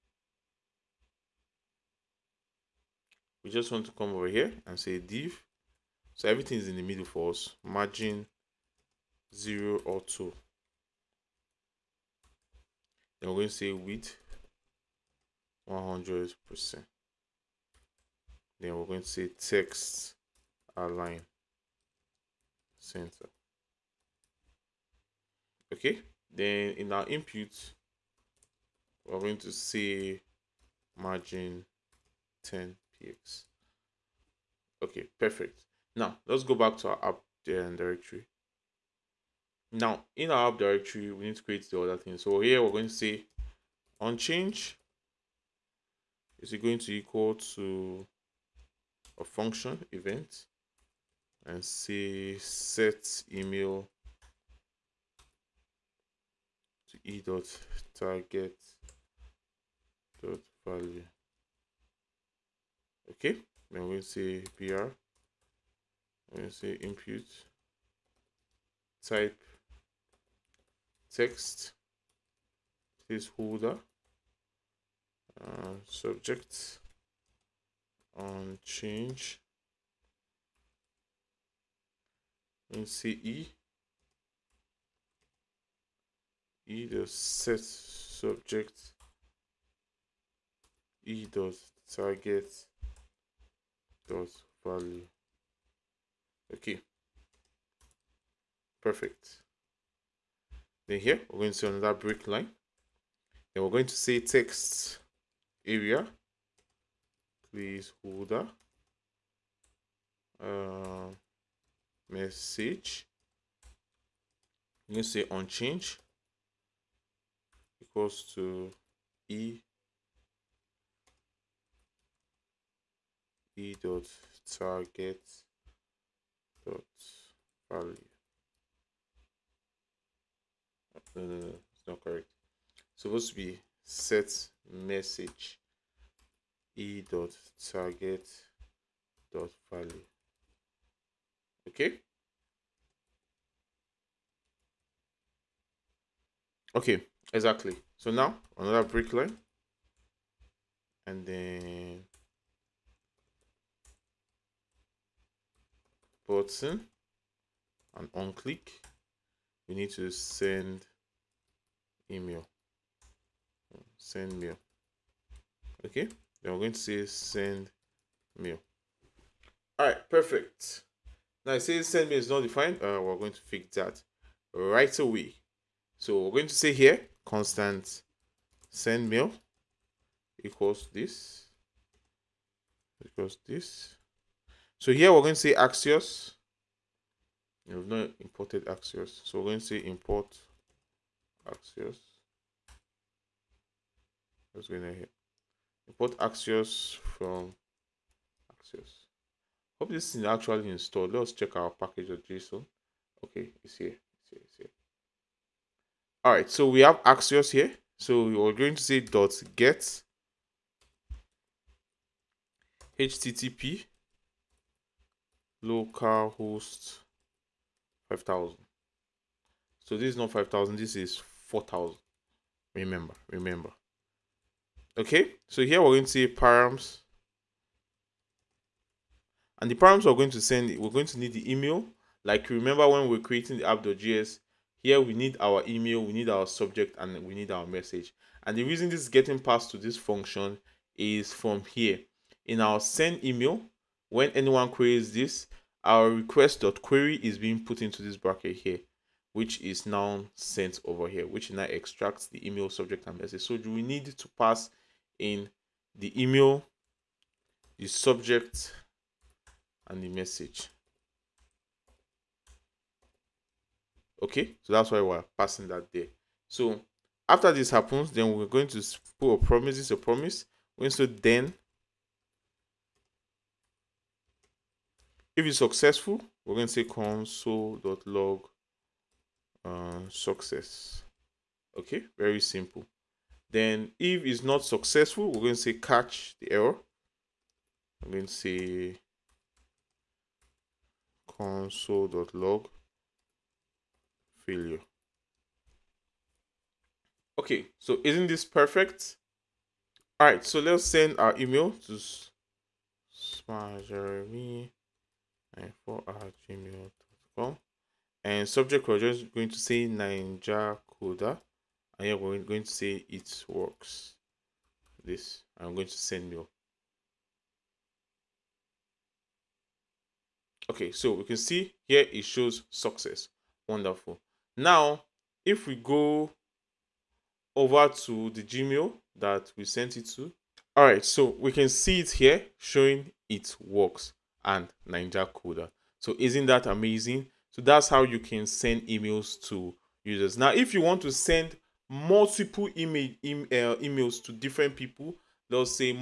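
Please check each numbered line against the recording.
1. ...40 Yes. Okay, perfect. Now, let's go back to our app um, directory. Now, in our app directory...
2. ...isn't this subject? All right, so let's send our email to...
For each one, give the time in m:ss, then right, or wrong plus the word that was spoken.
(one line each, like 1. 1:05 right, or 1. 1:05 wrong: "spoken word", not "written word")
1. 0:32 wrong: "10", not "40"
2. 4:58 wrong: "perfect", not "subject".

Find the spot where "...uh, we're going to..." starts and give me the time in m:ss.
2:52.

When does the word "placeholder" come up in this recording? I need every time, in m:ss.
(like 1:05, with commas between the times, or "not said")
1:13, 1:47.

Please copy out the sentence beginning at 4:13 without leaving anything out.
So we need to pass in the email, the subject, and the message.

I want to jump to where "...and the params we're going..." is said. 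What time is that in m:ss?
3:49.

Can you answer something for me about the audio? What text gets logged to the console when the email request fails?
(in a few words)
failure.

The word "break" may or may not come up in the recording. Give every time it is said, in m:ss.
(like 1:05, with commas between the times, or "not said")
1:41, 2:28.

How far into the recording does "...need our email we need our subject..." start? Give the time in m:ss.
3:55.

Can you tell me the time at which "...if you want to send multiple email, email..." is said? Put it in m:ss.
5:40.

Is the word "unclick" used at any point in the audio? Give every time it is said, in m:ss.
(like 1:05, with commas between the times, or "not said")
2:38.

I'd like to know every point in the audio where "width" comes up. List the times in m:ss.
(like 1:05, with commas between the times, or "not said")
0:13.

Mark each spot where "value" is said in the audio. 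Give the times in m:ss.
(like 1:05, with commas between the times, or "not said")
1:00, 1:34, 2:07, 2:19.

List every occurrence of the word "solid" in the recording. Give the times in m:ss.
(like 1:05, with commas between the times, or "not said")
not said.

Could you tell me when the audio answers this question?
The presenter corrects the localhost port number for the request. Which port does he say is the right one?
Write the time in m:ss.
3:40.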